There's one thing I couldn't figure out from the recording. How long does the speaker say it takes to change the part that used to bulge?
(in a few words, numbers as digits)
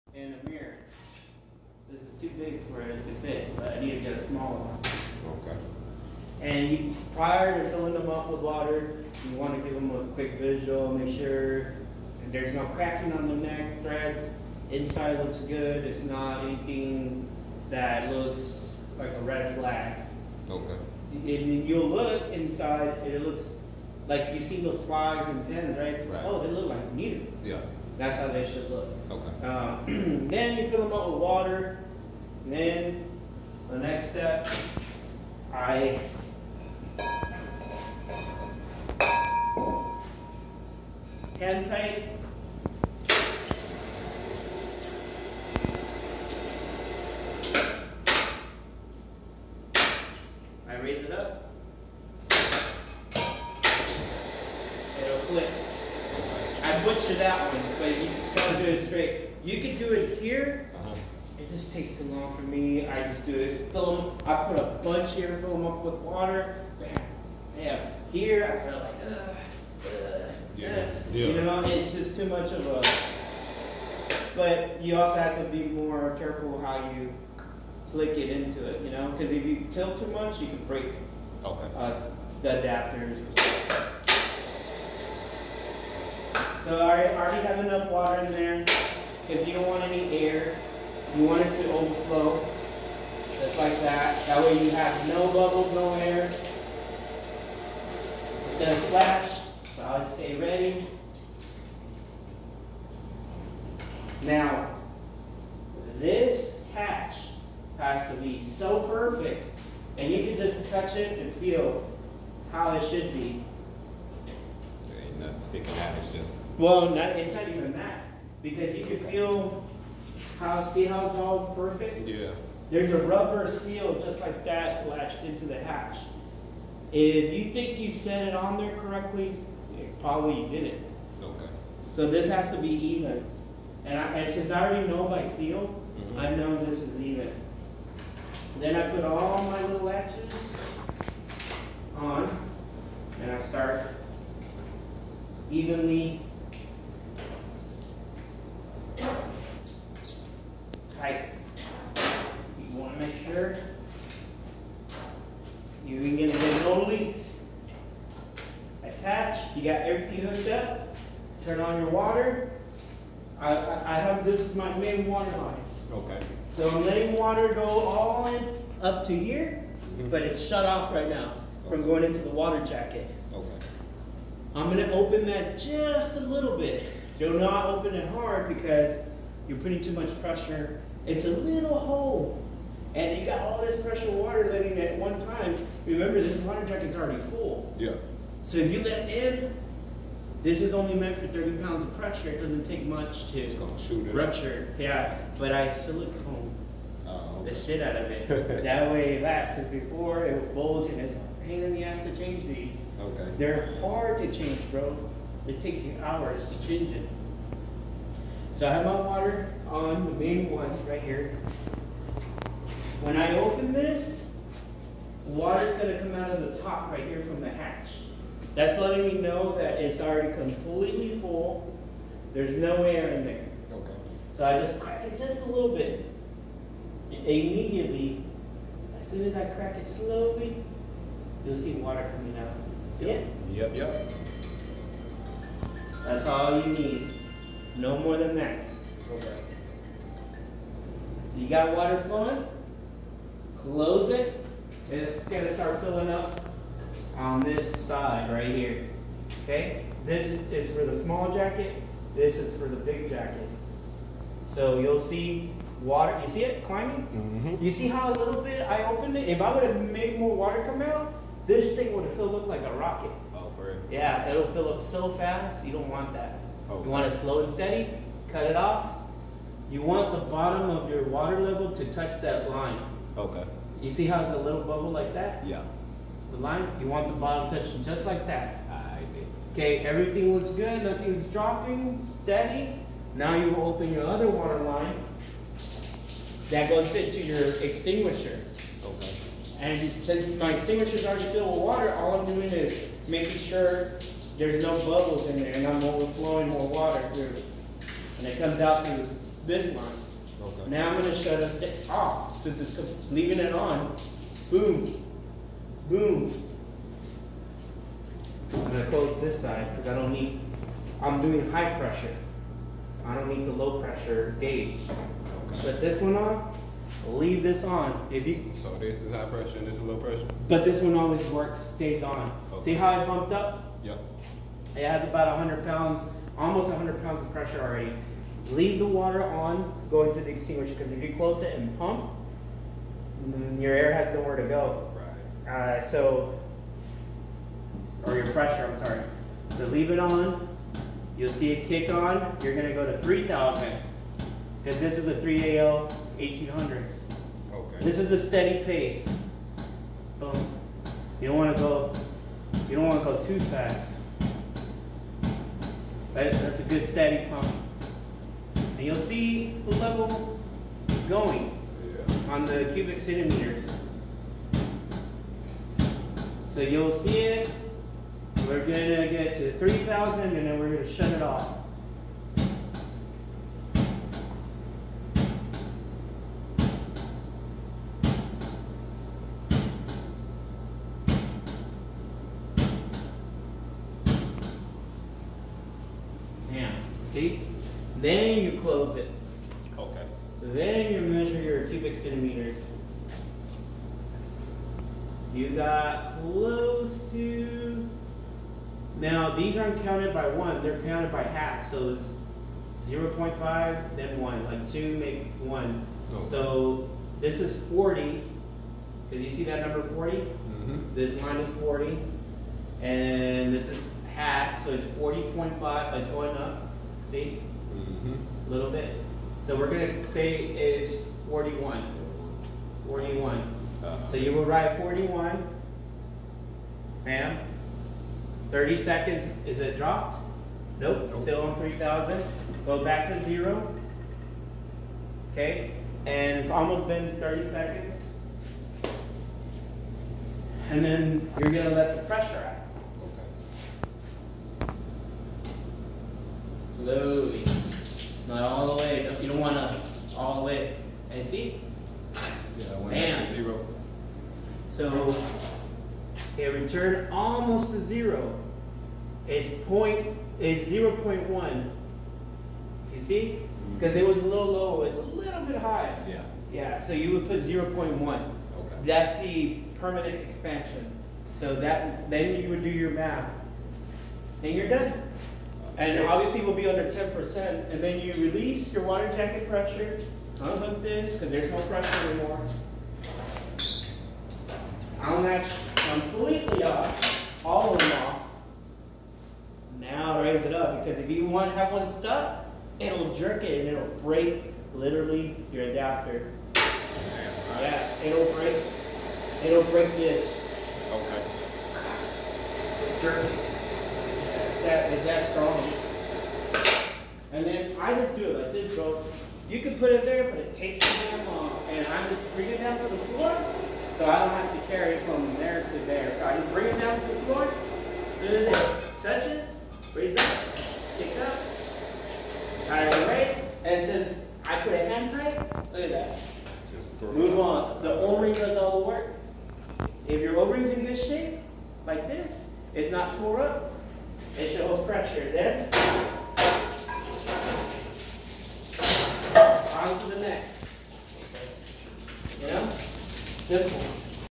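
hours.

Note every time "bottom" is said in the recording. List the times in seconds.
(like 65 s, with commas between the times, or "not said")
270 s, 277 s.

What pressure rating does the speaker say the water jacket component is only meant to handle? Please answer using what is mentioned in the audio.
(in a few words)
30 pounds.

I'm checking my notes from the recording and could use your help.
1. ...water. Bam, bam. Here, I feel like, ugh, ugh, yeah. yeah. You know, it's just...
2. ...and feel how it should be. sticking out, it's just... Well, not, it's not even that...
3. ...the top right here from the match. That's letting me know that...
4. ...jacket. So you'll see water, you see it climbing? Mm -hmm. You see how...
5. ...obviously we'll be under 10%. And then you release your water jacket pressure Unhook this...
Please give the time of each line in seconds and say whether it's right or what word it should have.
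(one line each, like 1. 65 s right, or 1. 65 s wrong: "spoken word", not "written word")
1. 65 s right
2. 111 s right
3. 216 s wrong: "hatch", not "match"
4. 253 s right
5. 476 s right.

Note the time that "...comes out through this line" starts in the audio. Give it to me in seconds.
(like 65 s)
298 s.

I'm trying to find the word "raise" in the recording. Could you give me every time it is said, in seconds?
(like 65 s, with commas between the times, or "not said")
50 s, 490 s, 519 s.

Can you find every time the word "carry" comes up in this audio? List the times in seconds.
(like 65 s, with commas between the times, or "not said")
514 s.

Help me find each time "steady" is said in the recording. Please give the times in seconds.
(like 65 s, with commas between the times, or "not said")
267 s, 282 s, 348 s, 356 s.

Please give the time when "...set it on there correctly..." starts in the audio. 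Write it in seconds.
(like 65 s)
127 s.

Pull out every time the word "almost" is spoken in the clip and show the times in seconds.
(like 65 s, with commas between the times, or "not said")
326 s, 436 s, 457 s.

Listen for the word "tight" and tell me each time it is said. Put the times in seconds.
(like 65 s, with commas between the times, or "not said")
41 s, 525 s.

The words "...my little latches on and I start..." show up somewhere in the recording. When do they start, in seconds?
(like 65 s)
139 s.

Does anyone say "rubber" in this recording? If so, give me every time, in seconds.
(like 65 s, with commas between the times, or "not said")
123 s.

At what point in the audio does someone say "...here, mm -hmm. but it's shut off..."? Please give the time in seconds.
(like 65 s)
169 s.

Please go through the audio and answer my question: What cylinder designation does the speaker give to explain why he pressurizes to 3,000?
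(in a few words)
3AL 1800.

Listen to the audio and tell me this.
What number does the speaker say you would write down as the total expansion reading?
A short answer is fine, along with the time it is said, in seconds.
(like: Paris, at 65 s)
41, at 424 s.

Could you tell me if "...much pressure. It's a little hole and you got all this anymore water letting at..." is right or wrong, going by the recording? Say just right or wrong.
wrong.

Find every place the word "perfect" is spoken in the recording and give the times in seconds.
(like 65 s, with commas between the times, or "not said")
108 s, 121 s.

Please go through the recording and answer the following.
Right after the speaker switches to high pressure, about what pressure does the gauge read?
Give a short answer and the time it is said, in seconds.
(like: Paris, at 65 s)
100 pounds, at 326 s.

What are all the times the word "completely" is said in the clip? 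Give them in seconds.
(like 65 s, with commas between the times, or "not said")
220 s, 485 s.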